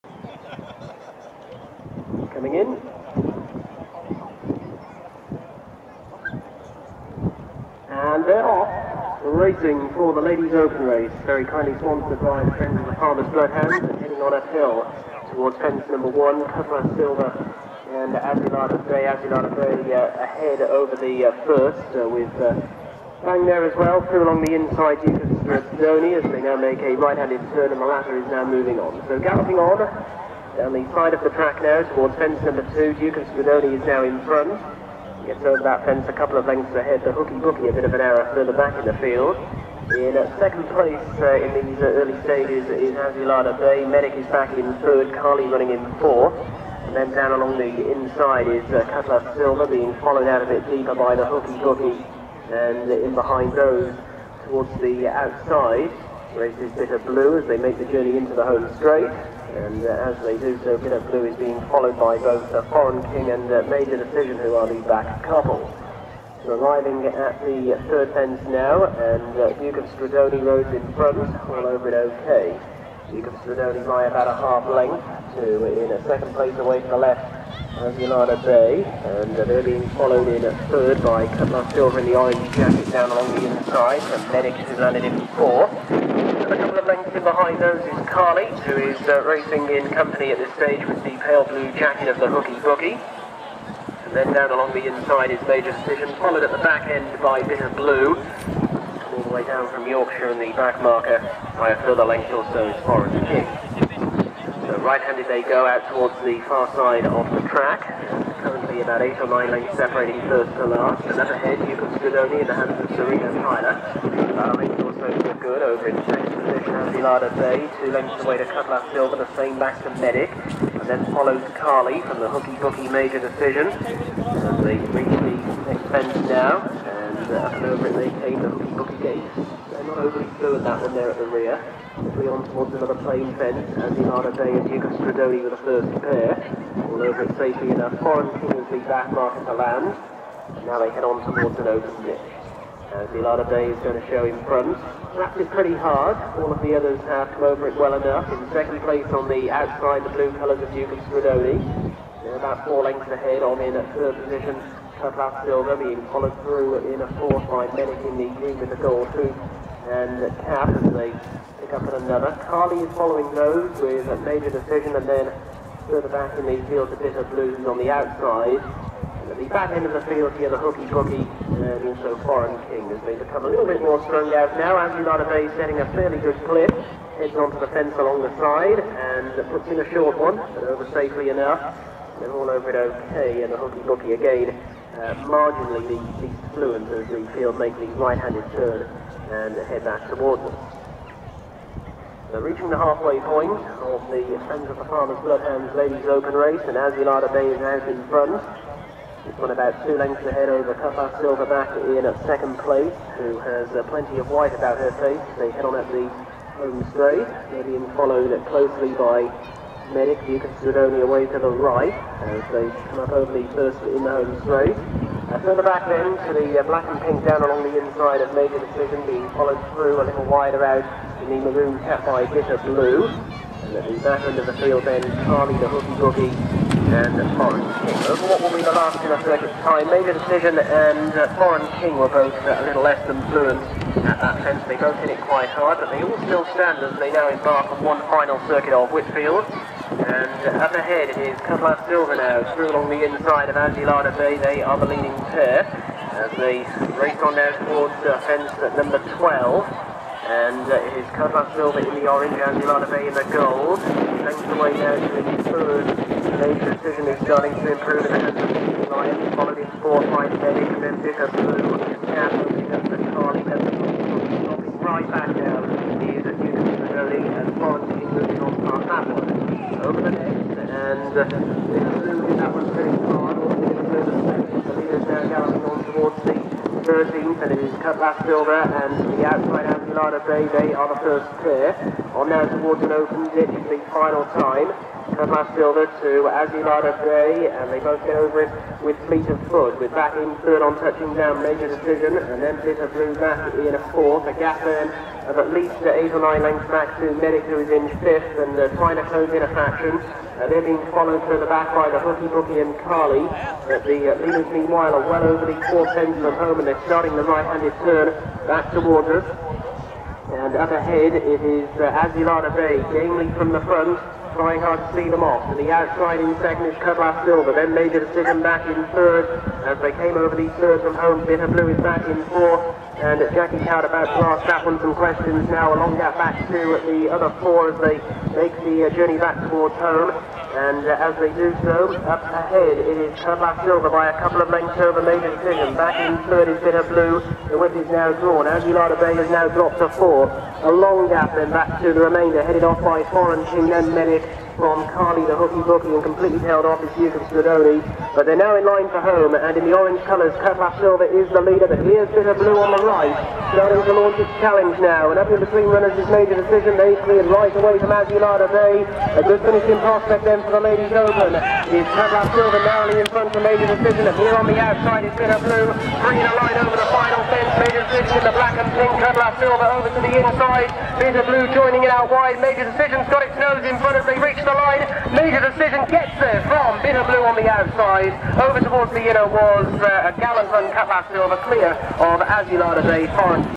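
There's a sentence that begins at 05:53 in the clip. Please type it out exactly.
starting to launch its challenge now, and up in between runners is made a decision.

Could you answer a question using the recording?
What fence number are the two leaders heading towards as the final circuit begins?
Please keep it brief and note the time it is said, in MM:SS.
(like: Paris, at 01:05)
12, at 04:09.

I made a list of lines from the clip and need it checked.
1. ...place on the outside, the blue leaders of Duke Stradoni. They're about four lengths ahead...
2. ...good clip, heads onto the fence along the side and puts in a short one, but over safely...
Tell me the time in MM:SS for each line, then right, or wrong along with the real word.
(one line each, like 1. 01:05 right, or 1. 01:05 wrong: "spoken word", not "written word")
1. 02:28 wrong: "colours", not "leaders"
2. 02:56 right.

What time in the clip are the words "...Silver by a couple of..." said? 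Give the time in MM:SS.
05:33.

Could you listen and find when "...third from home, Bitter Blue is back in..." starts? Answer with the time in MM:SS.
05:20.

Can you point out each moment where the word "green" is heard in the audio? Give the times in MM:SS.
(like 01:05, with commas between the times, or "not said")
02:38.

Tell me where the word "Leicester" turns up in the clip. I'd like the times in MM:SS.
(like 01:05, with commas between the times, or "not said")
04:31.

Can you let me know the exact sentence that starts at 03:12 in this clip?
are reaching the halfway point of the Friends of the Farmers Bloodhounds Ladies Open Race, and Azulada Bay is out in front.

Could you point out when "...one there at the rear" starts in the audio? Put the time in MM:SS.
02:10.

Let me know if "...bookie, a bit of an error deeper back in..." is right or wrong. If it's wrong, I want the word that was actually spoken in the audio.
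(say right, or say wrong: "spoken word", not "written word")
wrong: "further", not "deeper".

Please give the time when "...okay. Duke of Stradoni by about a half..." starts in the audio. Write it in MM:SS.
01:11.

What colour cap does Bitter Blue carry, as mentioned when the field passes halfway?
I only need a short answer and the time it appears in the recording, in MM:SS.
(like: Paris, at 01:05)
Maroon, at 03:41.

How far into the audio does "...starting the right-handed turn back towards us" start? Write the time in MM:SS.
05:06.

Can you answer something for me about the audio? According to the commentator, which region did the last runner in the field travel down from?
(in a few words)
Yorkshire.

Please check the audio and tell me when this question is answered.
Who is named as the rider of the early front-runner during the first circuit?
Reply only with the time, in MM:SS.
01:52.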